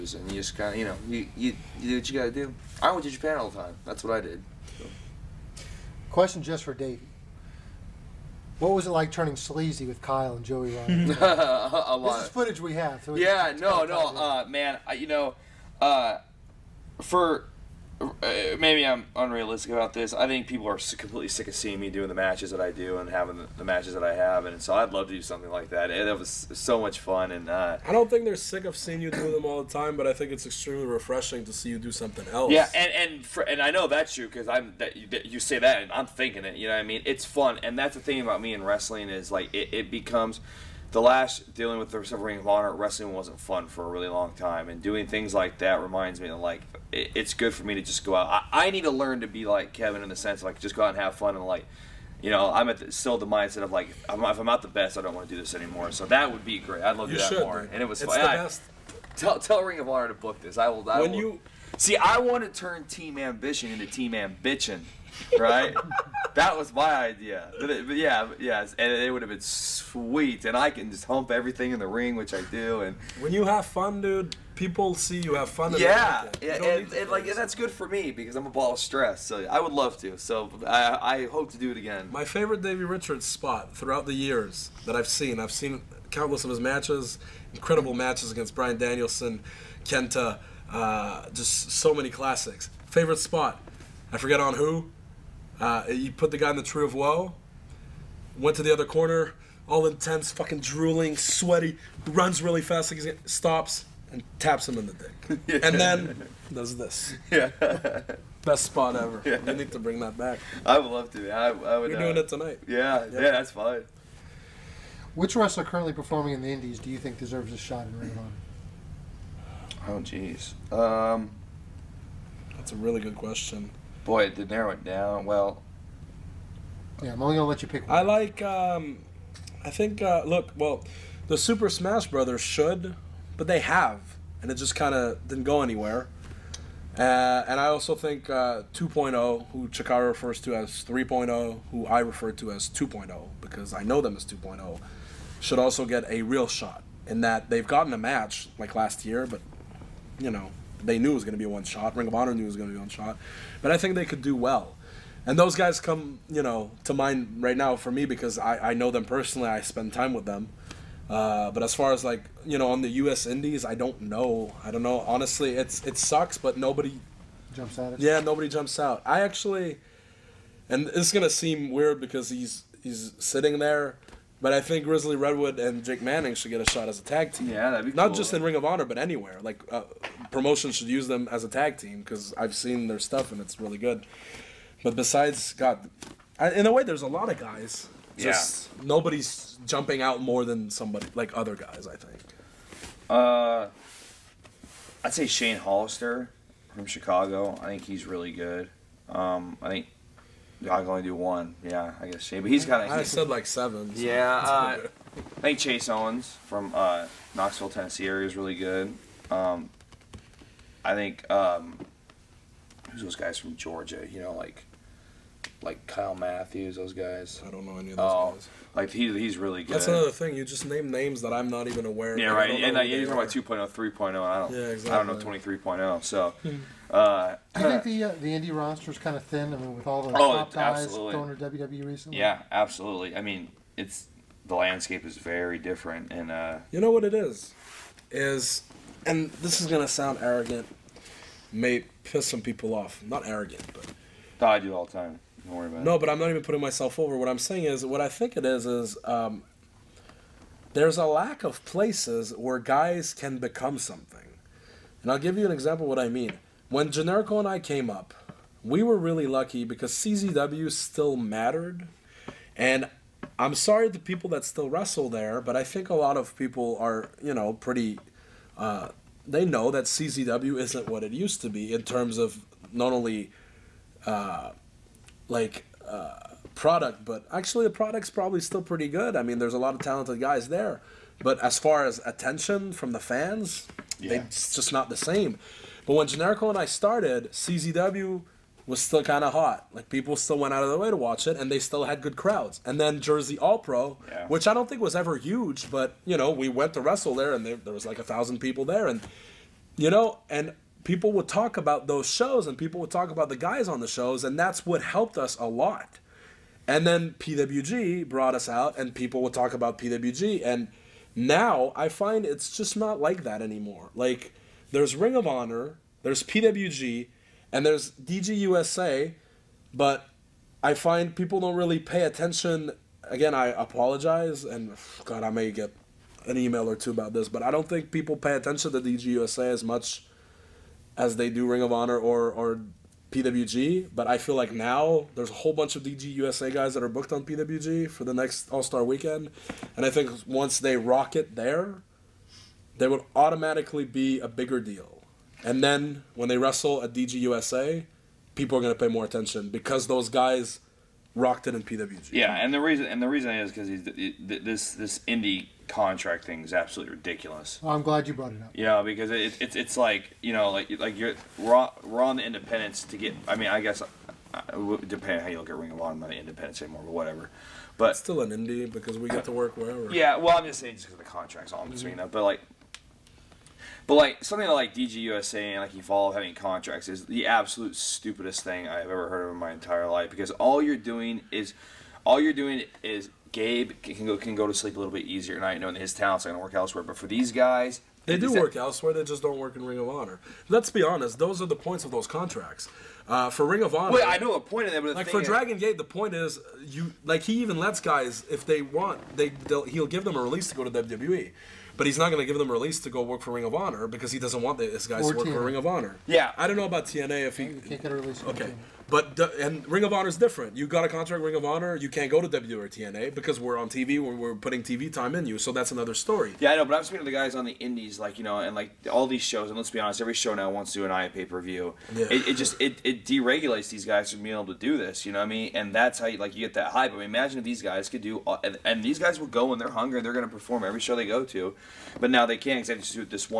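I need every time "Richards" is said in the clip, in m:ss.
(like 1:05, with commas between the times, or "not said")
1:22.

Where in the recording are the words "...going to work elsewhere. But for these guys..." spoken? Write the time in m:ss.
6:26.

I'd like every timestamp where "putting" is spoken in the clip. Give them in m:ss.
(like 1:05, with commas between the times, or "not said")
4:06, 6:54.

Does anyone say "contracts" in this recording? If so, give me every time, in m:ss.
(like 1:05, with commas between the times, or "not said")
5:55, 6:11, 6:16, 6:32, 6:50.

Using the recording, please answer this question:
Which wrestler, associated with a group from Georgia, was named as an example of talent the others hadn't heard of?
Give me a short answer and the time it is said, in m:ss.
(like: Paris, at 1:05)
Kyle Matthews, at 3:35.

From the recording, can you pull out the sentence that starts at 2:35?
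And those guys come, you know, to mind right now for me because I, I know them personally.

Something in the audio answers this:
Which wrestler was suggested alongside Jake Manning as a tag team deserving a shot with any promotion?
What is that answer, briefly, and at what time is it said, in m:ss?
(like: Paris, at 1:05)
Grizzly Redwood, at 2:54.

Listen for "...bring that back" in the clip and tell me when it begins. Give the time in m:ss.
1:49.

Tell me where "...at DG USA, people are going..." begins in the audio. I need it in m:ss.
5:46.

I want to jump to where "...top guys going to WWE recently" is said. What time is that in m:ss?
3:50.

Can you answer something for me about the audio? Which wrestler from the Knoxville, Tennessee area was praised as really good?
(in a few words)
Chase Owens.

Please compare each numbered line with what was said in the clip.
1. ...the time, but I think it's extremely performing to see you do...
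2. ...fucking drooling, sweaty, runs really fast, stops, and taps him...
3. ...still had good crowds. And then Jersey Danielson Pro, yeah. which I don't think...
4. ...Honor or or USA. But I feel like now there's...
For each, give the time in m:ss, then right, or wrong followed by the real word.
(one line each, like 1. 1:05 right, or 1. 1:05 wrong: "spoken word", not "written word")
1. 0:29 wrong: "refreshing", not "performing"
2. 1:40 right
3. 4:51 wrong: "All", not "Danielson"
4. 5:31 wrong: "PWG", not "USA".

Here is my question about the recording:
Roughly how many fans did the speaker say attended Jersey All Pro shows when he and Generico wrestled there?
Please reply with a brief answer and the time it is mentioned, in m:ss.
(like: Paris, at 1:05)
1,000, at 4:57.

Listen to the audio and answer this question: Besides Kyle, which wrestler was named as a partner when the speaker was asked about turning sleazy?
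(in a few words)
Joey Ryan.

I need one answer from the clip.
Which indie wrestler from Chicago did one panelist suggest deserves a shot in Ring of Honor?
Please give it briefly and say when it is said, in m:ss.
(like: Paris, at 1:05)
Shane Hollister, at 3:15.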